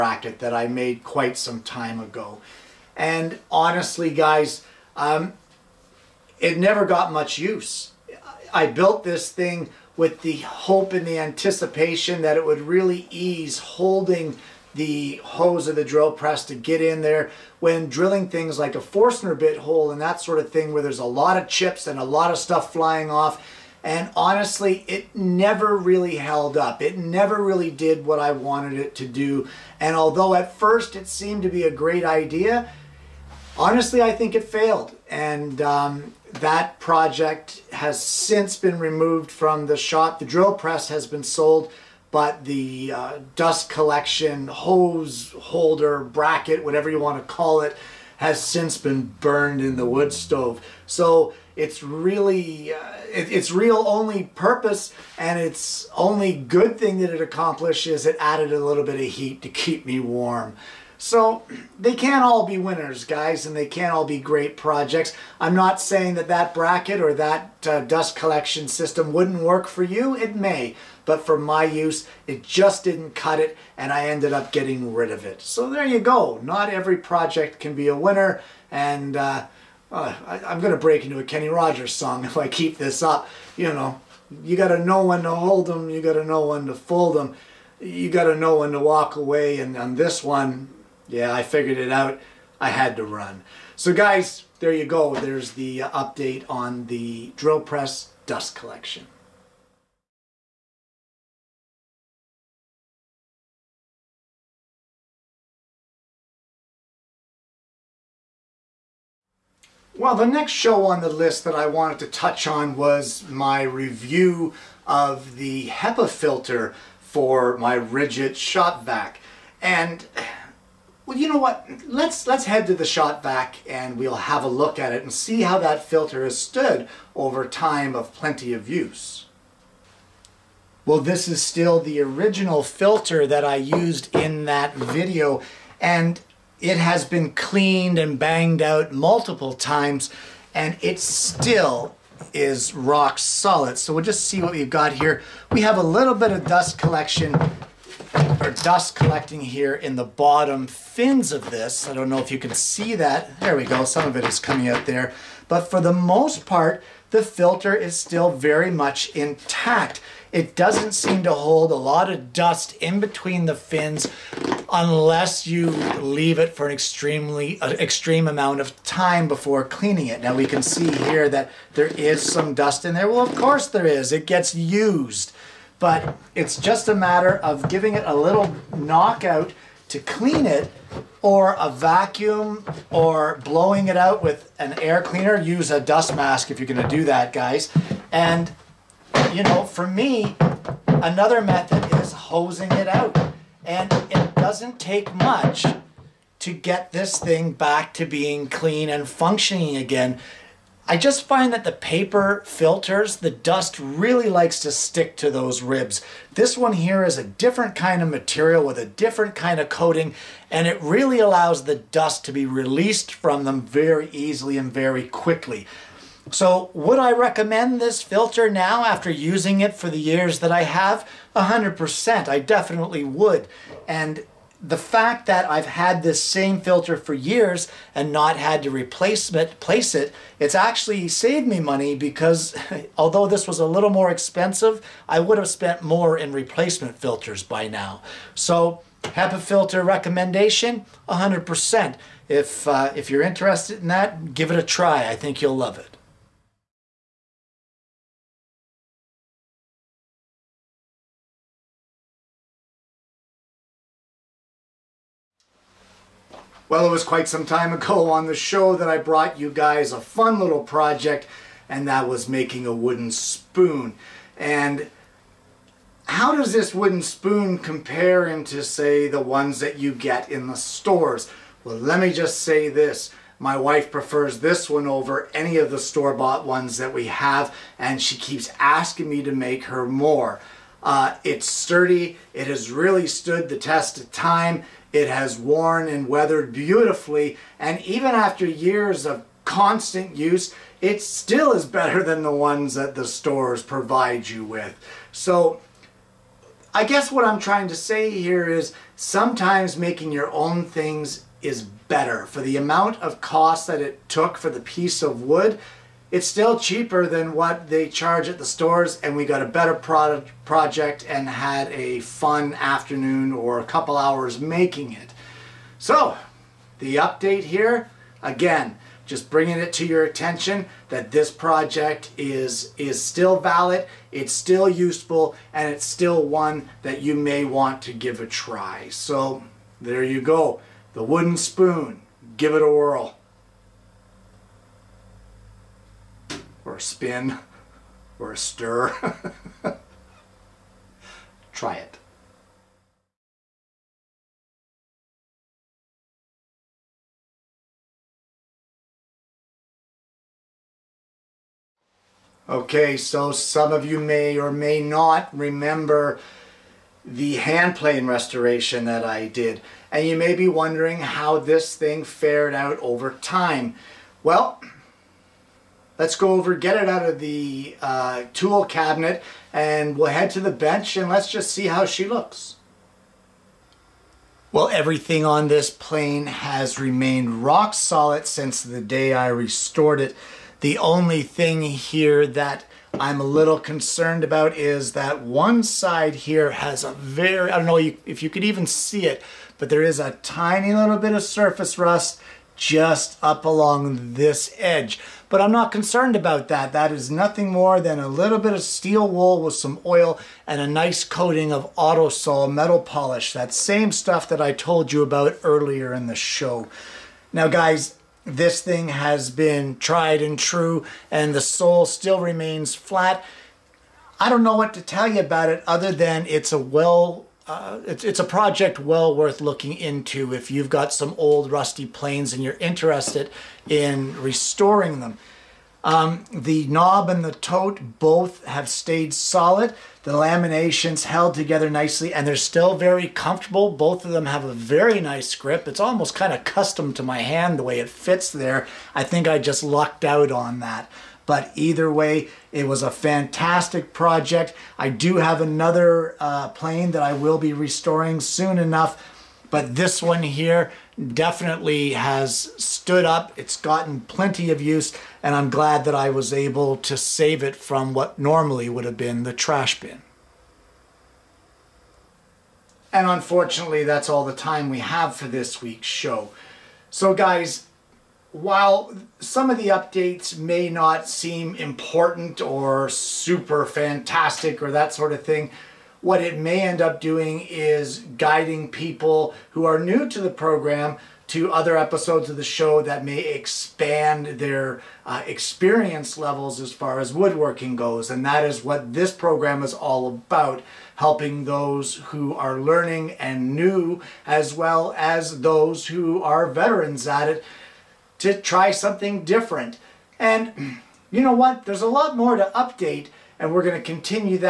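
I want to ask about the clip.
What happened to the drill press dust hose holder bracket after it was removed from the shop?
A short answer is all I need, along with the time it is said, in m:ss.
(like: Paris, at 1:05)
Burned in the wood stove, at 0:49.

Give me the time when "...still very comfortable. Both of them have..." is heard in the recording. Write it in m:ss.
7:12.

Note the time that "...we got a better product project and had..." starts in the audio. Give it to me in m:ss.
5:09.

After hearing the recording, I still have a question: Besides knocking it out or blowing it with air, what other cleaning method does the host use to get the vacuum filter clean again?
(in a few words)
Hosing it out.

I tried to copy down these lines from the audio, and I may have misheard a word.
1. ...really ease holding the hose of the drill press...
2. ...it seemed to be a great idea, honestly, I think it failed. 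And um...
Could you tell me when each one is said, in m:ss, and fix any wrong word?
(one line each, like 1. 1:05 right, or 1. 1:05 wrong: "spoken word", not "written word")
1. 0:12 right
2. 0:30 right.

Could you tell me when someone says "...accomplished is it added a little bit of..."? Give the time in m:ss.
0:57.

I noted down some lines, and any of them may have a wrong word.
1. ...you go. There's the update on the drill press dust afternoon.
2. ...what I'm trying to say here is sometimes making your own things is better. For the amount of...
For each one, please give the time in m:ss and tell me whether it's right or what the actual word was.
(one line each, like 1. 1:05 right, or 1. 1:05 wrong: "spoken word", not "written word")
1. 1:34 wrong: "collection", not "afternoon"
2. 4:57 right.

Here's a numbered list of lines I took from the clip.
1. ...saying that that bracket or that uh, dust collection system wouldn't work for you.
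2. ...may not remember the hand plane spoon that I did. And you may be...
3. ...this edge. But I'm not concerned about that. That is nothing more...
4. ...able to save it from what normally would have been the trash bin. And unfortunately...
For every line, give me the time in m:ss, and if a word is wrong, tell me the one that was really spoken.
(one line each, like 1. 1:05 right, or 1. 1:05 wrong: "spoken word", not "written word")
1. 1:05 right
2. 5:54 wrong: "restoration", not "spoon"
3. 6:34 right
4. 7:36 right.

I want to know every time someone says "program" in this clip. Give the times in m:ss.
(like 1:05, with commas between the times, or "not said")
8:00, 8:09.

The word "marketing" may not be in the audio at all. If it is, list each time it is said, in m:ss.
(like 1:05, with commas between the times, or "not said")
not said.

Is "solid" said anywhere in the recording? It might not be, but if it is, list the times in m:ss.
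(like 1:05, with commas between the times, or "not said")
2:23, 6:17, 7:09.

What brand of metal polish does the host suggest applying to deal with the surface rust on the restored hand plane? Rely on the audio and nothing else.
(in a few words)
Autosol.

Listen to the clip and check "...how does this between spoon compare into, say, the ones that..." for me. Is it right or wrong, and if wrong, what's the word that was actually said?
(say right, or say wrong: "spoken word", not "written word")
wrong: "wooden", not "between".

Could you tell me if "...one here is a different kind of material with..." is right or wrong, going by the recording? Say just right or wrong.
right.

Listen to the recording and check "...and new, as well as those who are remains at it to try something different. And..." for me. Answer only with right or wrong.
wrong.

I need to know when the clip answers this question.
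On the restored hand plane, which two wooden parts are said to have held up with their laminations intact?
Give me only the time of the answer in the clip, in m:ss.
7:06.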